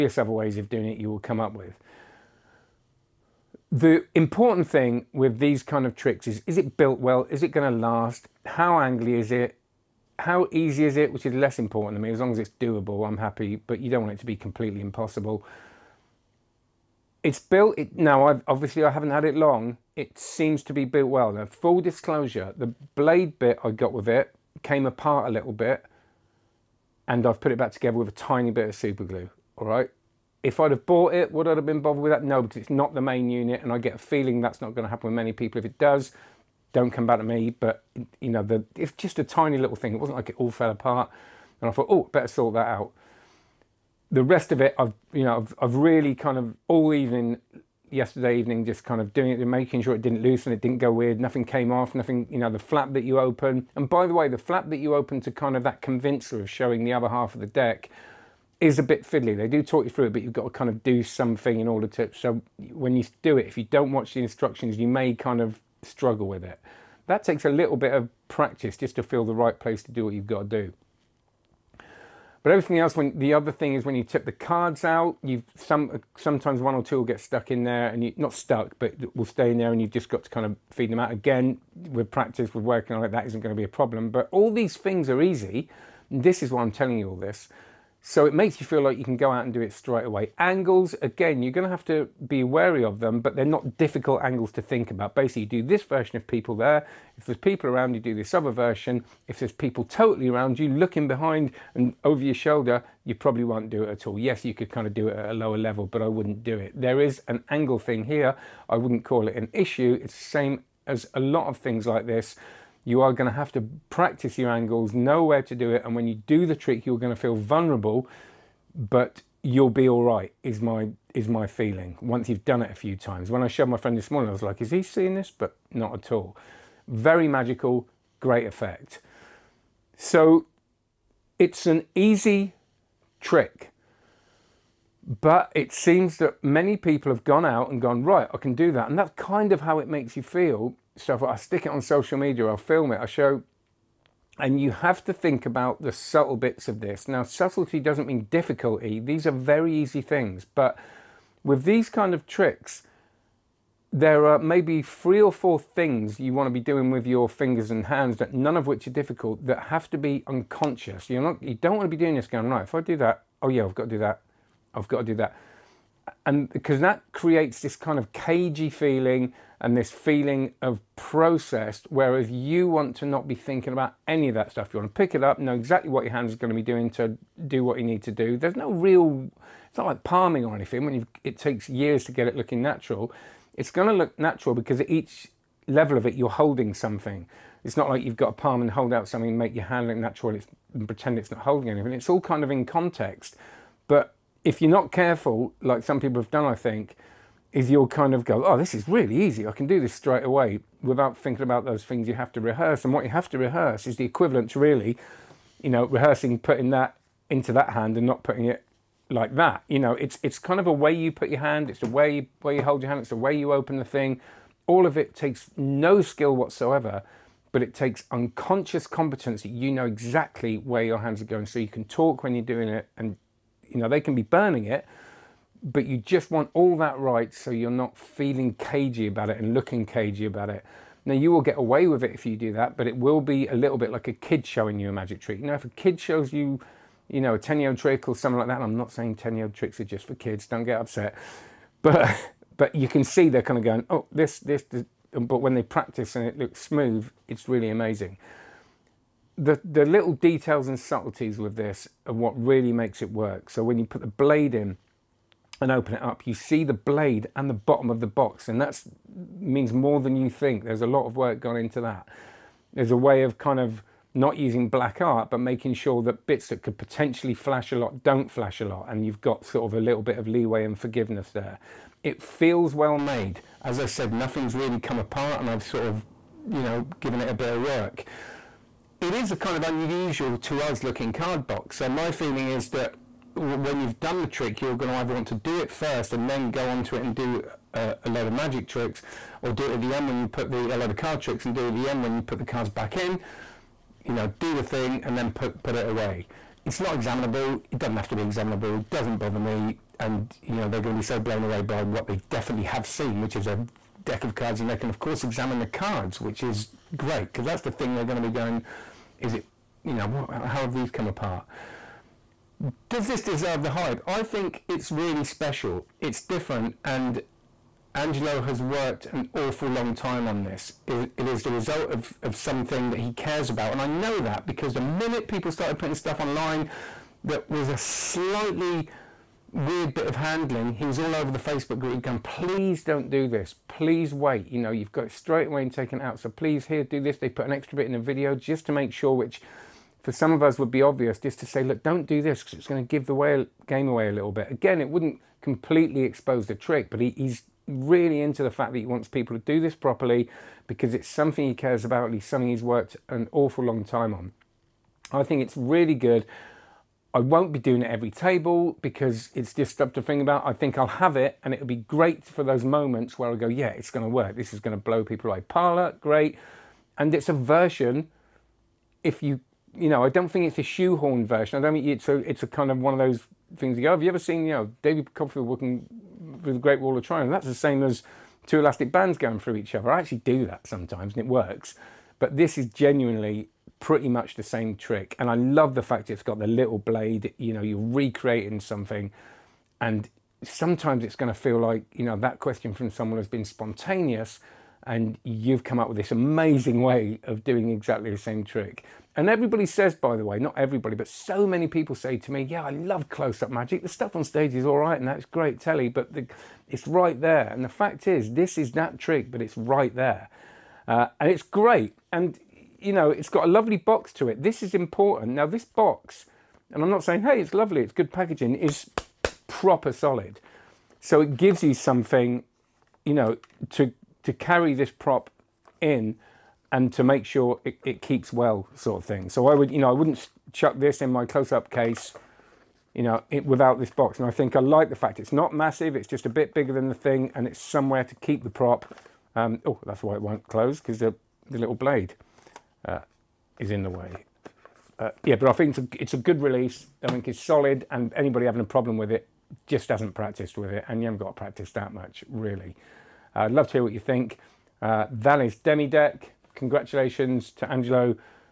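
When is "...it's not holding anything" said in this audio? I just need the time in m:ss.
3:11.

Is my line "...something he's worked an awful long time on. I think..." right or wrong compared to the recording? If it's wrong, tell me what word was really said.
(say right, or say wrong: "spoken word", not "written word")
right.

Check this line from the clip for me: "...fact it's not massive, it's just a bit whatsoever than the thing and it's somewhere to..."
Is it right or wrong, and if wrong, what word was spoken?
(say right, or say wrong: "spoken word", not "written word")
wrong: "bigger", not "whatsoever".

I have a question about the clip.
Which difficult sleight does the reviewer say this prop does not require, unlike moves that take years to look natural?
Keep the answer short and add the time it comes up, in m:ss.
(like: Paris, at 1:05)
palming, at 3:00.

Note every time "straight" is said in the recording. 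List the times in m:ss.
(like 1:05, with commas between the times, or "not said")
1:29, 3:19, 5:35.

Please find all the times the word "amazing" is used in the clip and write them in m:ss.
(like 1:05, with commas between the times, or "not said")
4:07, 6:36.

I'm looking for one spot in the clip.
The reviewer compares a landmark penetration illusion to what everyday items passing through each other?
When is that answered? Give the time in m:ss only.
6:18.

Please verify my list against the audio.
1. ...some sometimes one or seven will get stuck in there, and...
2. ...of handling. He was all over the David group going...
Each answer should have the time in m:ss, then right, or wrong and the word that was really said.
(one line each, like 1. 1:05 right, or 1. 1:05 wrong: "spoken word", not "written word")
1. 1:15 wrong: "two", not "seven"
2. 5:30 wrong: "Facebook", not "David".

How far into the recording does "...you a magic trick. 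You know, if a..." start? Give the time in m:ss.
3:54.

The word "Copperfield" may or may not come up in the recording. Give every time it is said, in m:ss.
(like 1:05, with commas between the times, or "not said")
6:15.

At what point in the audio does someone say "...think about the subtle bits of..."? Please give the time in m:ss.
2:25.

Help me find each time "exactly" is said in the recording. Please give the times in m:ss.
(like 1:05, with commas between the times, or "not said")
2:55, 3:39, 6:37.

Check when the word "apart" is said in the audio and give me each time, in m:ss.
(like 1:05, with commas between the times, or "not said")
0:24, 0:40, 4:34, 5:11.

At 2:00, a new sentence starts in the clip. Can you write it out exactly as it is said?
Is my is my feeling once you've done it a few times.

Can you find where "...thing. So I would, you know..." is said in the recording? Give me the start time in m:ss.
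7:09.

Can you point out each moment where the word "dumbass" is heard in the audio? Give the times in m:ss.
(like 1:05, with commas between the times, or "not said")
not said.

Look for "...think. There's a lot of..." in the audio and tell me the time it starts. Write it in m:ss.
4:20.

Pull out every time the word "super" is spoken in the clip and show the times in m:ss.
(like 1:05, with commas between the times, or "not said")
0:28.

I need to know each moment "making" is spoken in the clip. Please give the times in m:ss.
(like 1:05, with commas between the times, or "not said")
0:49, 4:25.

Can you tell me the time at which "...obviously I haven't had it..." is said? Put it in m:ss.
0:18.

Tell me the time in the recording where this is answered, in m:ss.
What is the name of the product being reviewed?
7:35.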